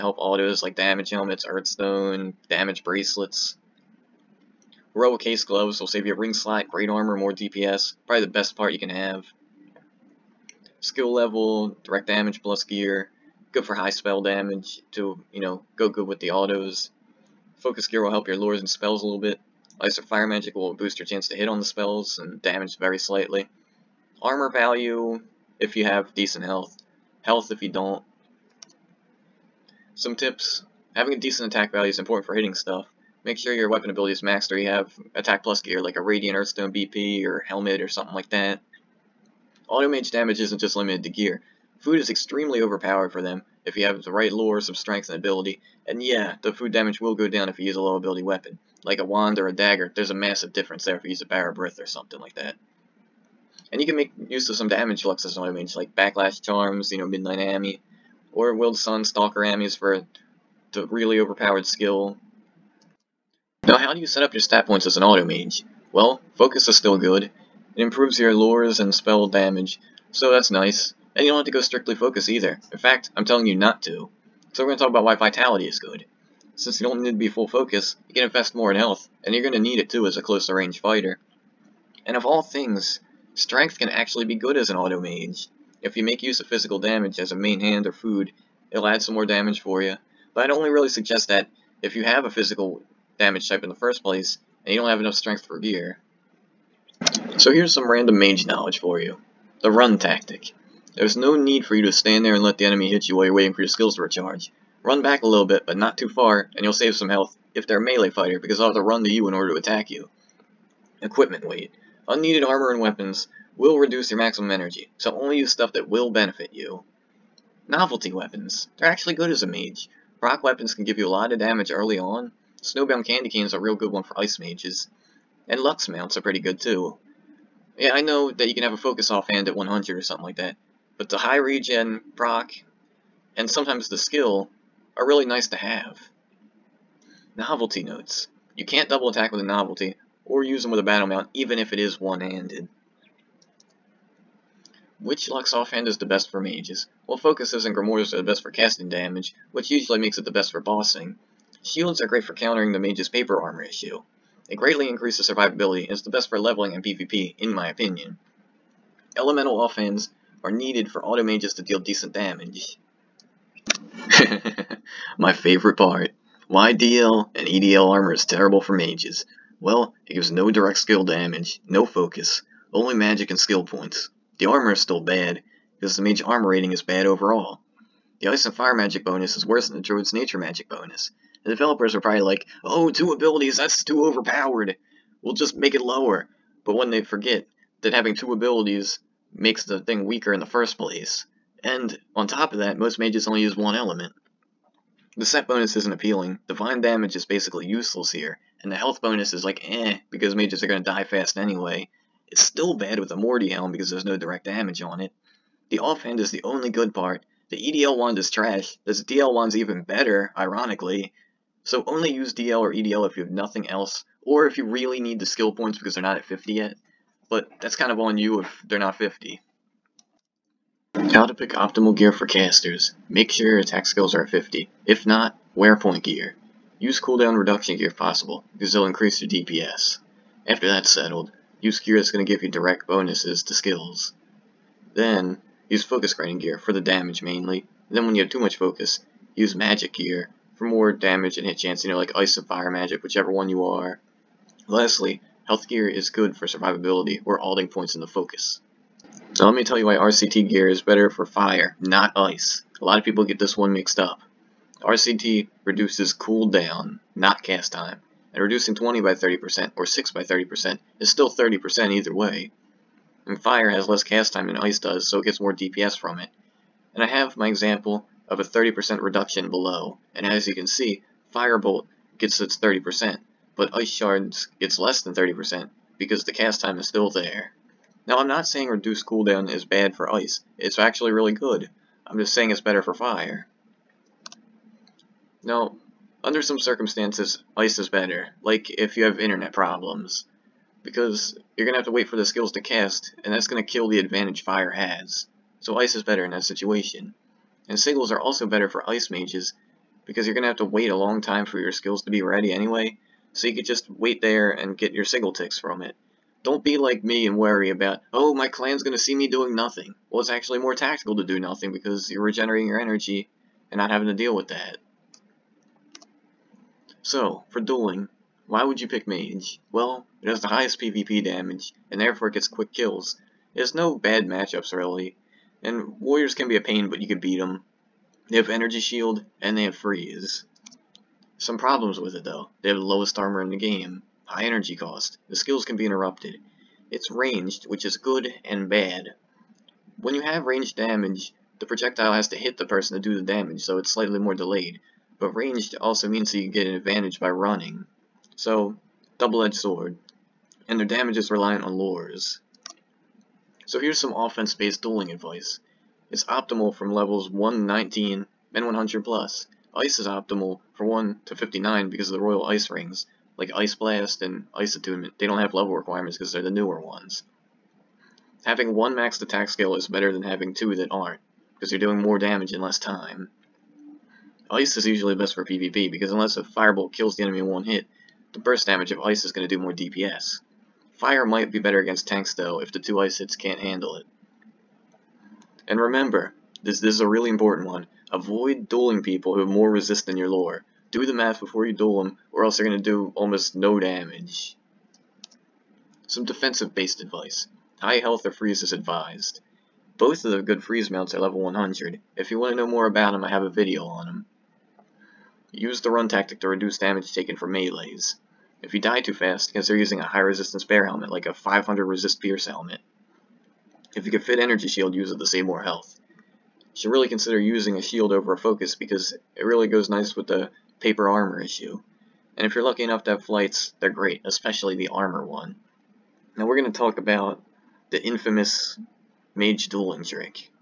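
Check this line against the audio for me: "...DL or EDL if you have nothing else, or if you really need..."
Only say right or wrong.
right.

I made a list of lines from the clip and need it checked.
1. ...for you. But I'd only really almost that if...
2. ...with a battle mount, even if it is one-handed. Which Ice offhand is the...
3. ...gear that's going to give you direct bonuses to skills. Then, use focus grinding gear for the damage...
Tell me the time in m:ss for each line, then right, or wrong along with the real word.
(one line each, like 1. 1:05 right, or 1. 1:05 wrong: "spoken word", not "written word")
1. 1:29 wrong: "suggest", not "almost"
2. 2:20 wrong: "Lux", not "Ice"
3. 3:51 right.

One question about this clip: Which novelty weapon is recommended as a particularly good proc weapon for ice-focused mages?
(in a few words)
Snowbound Candy Cane.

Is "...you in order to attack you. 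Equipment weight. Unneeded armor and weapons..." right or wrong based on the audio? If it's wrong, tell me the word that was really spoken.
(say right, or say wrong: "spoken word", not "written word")
right.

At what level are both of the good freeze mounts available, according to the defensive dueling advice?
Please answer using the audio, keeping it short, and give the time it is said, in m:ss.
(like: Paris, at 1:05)
100, at 6:41.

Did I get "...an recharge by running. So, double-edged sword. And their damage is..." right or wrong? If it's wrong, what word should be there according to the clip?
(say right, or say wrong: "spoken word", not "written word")
wrong: "advantage", not "recharge".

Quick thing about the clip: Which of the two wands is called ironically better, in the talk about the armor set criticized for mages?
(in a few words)
DL wand.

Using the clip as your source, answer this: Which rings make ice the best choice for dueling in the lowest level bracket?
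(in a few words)
Royal Ice Rings.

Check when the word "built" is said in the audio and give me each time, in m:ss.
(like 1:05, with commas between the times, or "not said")
not said.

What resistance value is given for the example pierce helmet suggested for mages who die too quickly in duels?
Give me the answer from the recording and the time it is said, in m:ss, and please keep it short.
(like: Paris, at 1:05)
500, at 6:51.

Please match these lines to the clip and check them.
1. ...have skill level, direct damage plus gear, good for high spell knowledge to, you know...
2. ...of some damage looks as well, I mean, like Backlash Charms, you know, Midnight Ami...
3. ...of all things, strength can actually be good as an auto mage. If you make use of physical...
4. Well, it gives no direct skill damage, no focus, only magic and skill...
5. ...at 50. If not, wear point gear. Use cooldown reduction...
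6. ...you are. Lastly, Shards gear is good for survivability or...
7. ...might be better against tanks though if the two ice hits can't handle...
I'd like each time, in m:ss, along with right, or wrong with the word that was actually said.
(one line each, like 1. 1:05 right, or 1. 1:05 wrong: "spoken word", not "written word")
1. 0:08 wrong: "damage", not "knowledge"
2. 0:54 right
3. 1:22 right
4. 2:49 right
5. 3:44 right
6. 4:03 wrong: "Health", not "Shards"
7. 6:21 right.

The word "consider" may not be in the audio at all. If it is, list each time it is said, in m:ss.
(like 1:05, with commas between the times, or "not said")
6:49, 6:57.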